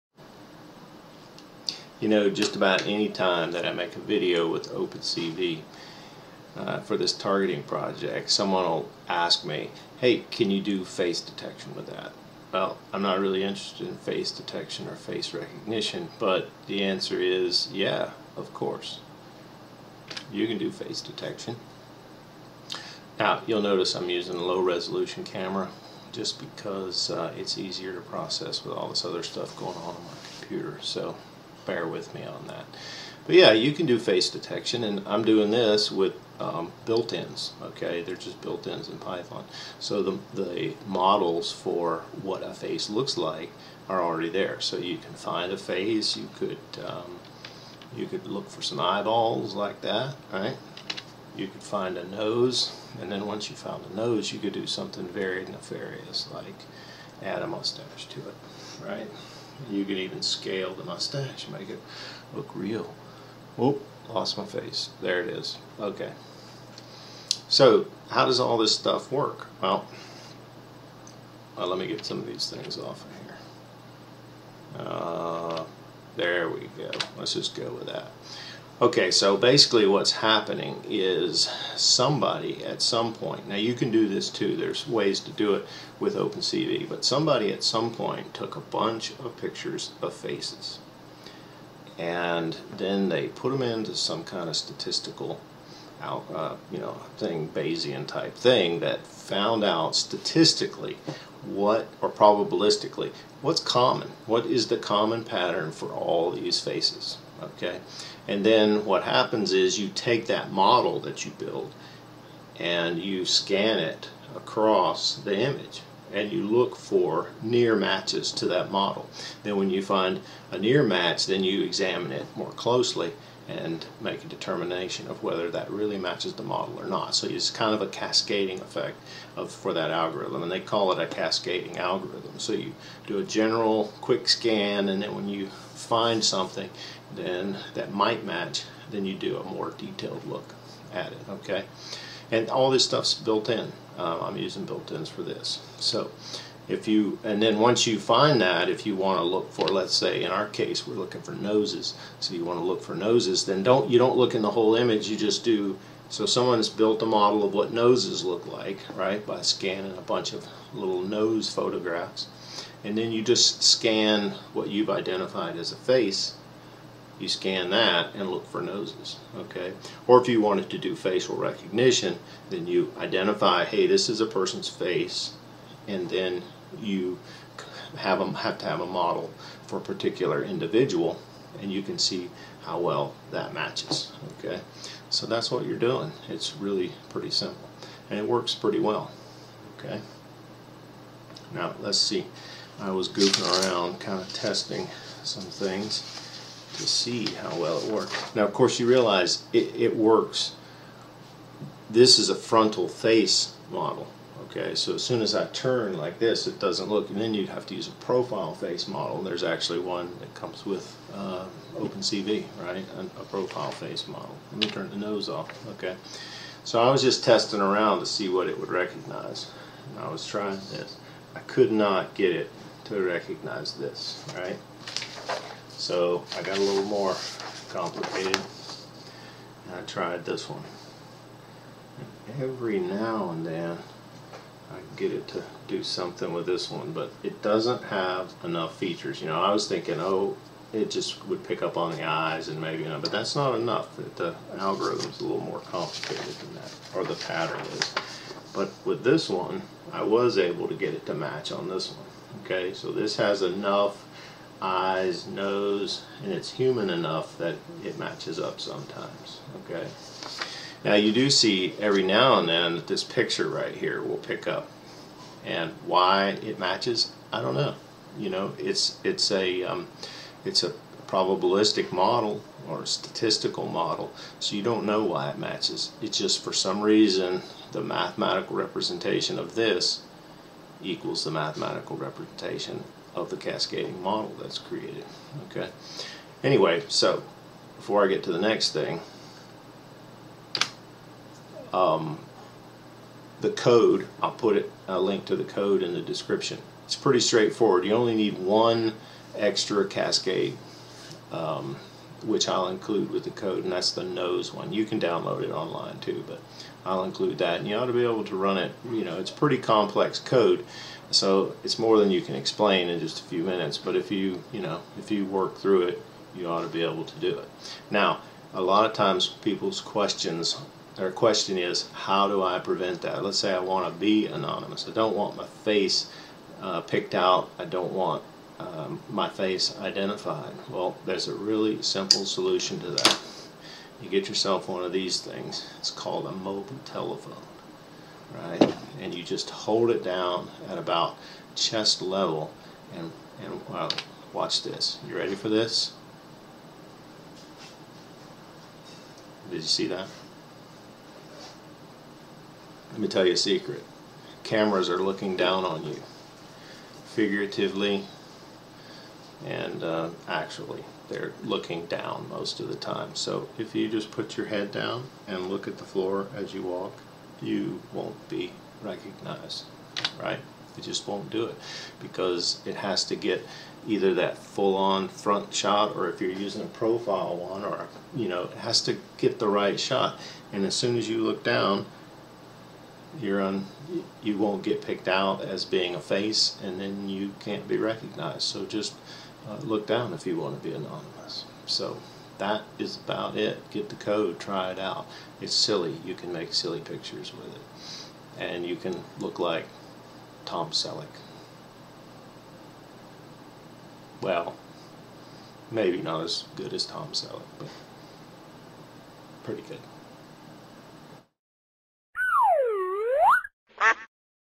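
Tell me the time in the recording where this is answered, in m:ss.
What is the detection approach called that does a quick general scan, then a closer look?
2:11.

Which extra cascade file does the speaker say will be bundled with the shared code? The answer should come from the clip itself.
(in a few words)
The nose one.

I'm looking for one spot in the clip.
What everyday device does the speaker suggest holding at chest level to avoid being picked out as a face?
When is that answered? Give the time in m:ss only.
5:36.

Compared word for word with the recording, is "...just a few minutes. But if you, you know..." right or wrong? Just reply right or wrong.
right.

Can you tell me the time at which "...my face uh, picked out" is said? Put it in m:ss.
5:25.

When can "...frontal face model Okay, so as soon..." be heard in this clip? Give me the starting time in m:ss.
3:22.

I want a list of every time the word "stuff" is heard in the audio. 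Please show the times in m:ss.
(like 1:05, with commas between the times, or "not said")
0:29, 1:08, 2:22.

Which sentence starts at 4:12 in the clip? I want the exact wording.
Okay, so this has enough eyes, nose, and it's human enough that it matches up sometimes.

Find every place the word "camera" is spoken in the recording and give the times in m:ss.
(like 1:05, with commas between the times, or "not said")
0:25, 5:54.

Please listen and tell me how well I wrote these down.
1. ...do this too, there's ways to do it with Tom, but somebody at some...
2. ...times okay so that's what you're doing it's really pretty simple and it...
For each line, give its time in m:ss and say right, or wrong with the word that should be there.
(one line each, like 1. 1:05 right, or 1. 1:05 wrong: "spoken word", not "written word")
1. 1:23 wrong: "OpenCV", not "Tom"
2. 3:03 wrong: "matches", not "times".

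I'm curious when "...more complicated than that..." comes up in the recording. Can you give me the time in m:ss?
4:05.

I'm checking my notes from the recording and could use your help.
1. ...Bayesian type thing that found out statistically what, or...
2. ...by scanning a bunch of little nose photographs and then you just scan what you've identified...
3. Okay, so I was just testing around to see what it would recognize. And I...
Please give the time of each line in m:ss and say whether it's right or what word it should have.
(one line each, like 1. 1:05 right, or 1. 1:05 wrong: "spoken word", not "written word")
1. 1:37 right
2. 2:39 right
3. 3:35 right.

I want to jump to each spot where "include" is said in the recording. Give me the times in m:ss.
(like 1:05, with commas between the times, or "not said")
5:02, 5:07.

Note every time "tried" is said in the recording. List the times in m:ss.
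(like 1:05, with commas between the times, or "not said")
3:49.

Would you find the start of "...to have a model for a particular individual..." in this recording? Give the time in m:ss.
2:58.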